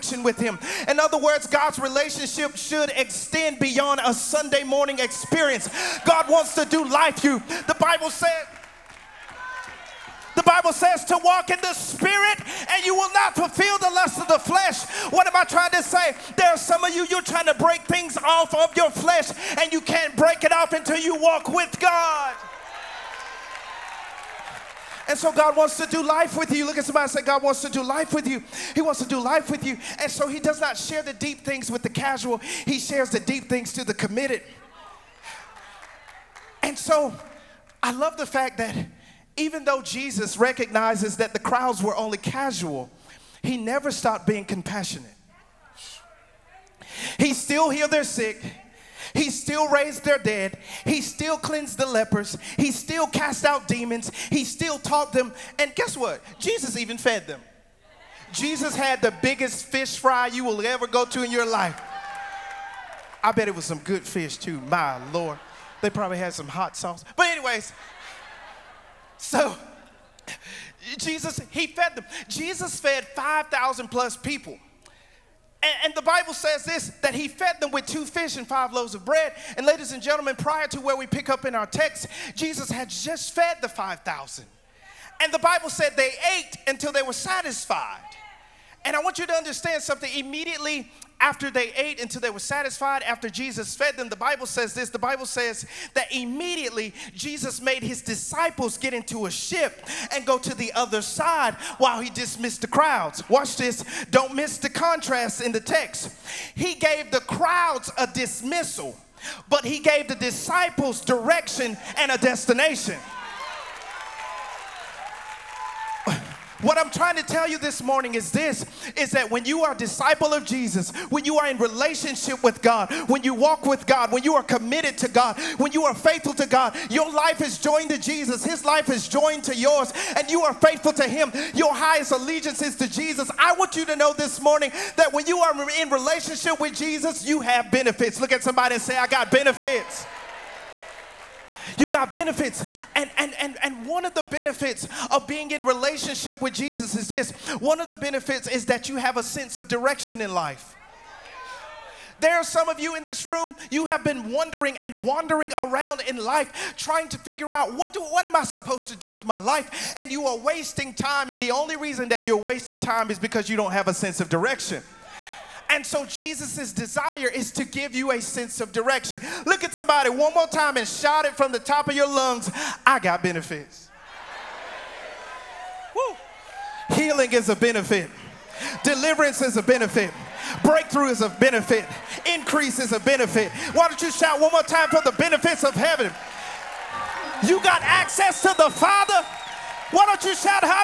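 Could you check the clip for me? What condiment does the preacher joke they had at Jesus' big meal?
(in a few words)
Hot sauce.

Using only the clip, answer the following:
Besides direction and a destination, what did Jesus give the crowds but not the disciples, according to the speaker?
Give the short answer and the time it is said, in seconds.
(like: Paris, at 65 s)
A dismissal, at 107 s.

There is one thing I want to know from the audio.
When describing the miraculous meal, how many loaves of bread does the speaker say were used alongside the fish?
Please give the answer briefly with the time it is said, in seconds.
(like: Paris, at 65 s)
5, at 78 s.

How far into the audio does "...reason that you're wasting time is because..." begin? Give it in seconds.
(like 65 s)
161 s.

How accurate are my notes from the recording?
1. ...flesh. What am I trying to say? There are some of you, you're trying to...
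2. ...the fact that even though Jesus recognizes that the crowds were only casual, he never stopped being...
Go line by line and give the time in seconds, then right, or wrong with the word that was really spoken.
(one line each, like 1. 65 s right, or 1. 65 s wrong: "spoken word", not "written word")
1. 14 s right
2. 38 s right.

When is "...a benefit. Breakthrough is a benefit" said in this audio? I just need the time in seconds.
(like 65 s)
179 s.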